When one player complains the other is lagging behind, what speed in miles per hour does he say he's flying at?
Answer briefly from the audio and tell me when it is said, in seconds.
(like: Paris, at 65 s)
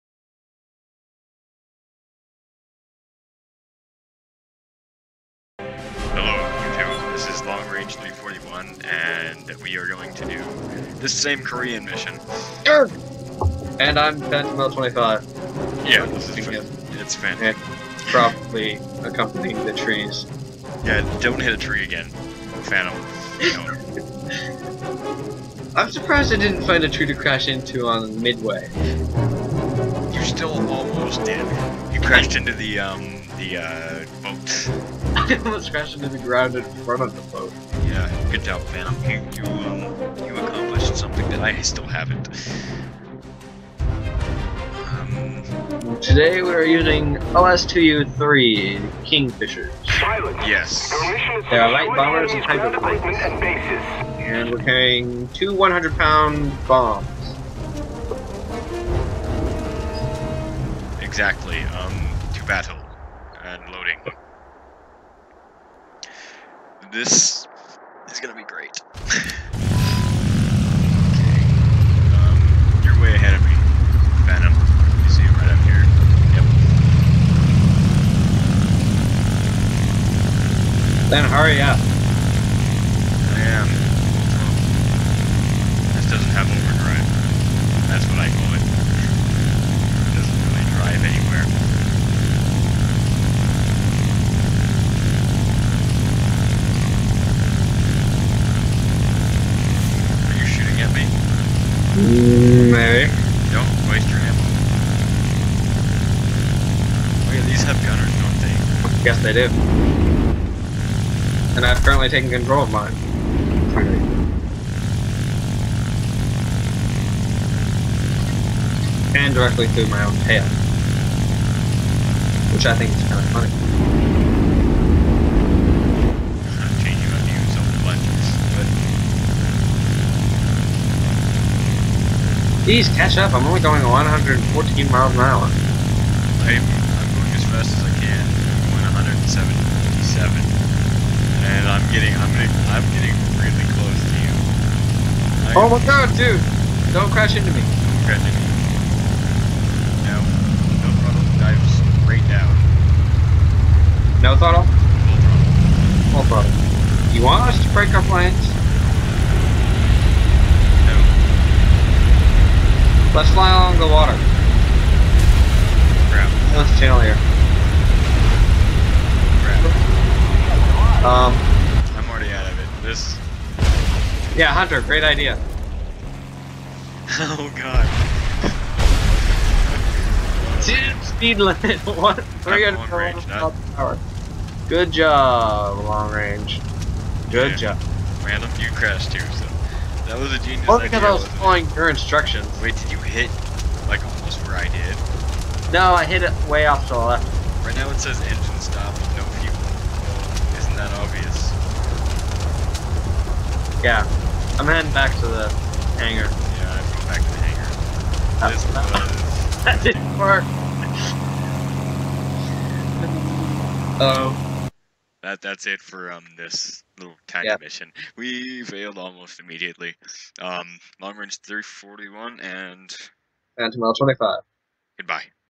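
114, at 133 s.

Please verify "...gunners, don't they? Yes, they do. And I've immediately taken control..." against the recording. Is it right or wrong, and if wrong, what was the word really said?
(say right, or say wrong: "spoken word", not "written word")
wrong: "currently", not "immediately".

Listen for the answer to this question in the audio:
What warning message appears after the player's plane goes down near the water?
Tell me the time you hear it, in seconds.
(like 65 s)
198 s.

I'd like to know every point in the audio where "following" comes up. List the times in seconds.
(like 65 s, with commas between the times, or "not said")
191 s.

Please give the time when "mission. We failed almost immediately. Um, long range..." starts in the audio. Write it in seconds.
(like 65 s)
217 s.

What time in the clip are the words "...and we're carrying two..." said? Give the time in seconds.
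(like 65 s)
54 s.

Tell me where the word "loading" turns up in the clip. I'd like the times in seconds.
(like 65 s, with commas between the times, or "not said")
63 s.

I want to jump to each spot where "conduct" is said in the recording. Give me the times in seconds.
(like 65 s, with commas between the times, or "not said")
not said.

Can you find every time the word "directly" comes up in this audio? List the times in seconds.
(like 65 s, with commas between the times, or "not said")
119 s.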